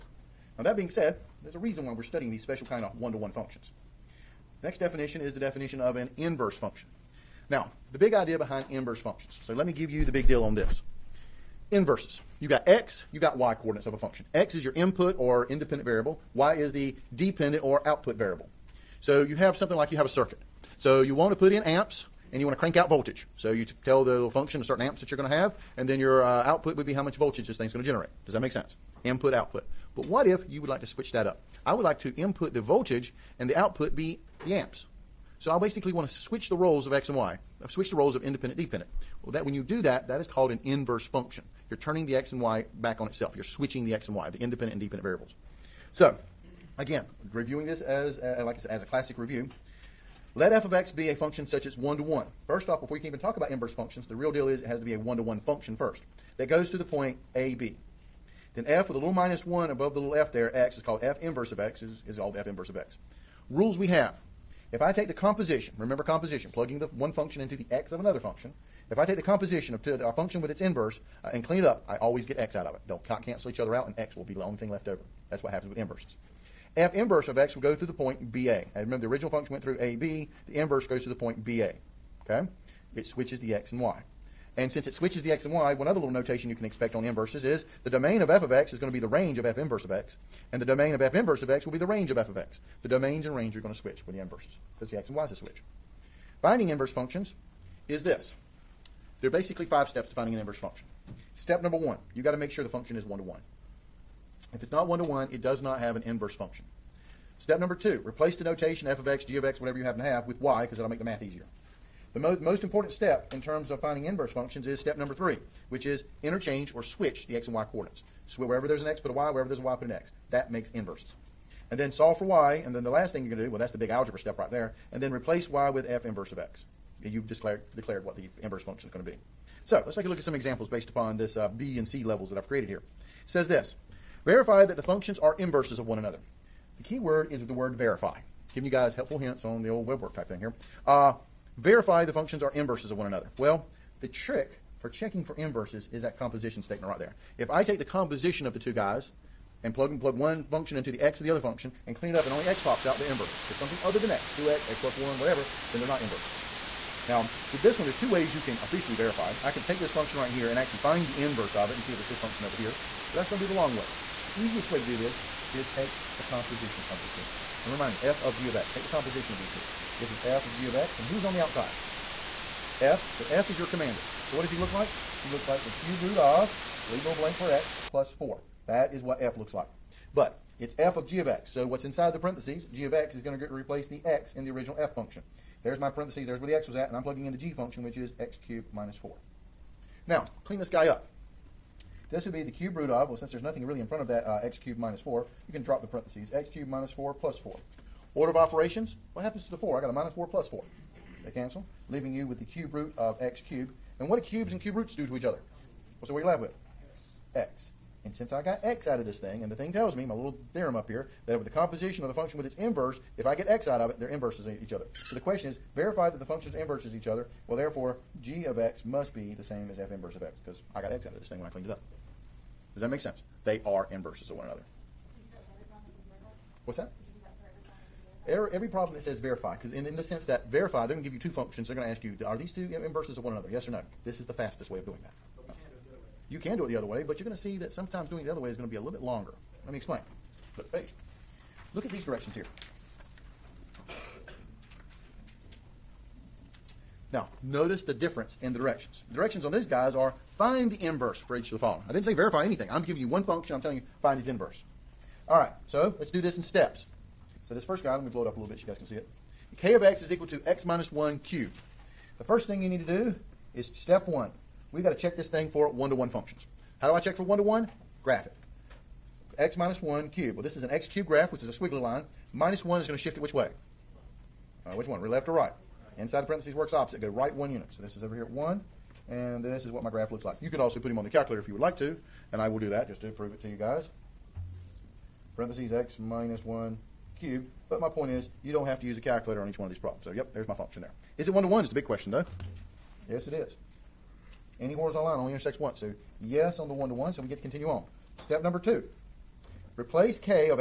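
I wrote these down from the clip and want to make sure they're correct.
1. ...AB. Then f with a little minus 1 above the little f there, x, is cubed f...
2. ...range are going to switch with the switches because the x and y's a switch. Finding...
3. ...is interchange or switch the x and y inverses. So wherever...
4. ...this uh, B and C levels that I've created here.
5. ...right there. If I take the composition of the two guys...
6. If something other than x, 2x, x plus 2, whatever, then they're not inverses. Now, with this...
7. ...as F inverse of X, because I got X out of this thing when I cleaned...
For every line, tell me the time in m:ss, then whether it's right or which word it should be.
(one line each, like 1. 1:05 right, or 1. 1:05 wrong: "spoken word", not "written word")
1. 0:57 wrong: "called", not "cubed"
2. 1:33 wrong: "inverses", not "switches"
3. 1:55 wrong: "coordinates", not "inverses"
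4. 2:11 right
5. 2:26 right
6. 2:33 wrong: "1", not "2"
7. 3:39 right.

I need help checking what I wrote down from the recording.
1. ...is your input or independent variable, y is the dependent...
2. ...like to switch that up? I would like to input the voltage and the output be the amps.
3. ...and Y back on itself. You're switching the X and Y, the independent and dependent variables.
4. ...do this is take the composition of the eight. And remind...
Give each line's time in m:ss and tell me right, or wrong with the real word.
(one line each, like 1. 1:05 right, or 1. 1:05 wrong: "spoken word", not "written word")
1. 0:14 right
2. 0:30 right
3. 0:42 right
4. 2:44 wrong: "two", not "eight".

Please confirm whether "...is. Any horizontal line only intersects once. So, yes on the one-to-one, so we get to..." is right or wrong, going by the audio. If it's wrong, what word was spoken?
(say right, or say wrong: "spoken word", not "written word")
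right.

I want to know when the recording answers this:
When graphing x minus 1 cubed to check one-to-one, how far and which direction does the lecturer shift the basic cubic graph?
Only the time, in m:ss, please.
4:37.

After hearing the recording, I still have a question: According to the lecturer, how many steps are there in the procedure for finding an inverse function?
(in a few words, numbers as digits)
5.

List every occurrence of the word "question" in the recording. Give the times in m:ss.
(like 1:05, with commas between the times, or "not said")
3:35, 4:51.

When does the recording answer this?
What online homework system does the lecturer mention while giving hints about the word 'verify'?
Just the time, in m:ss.
2:19.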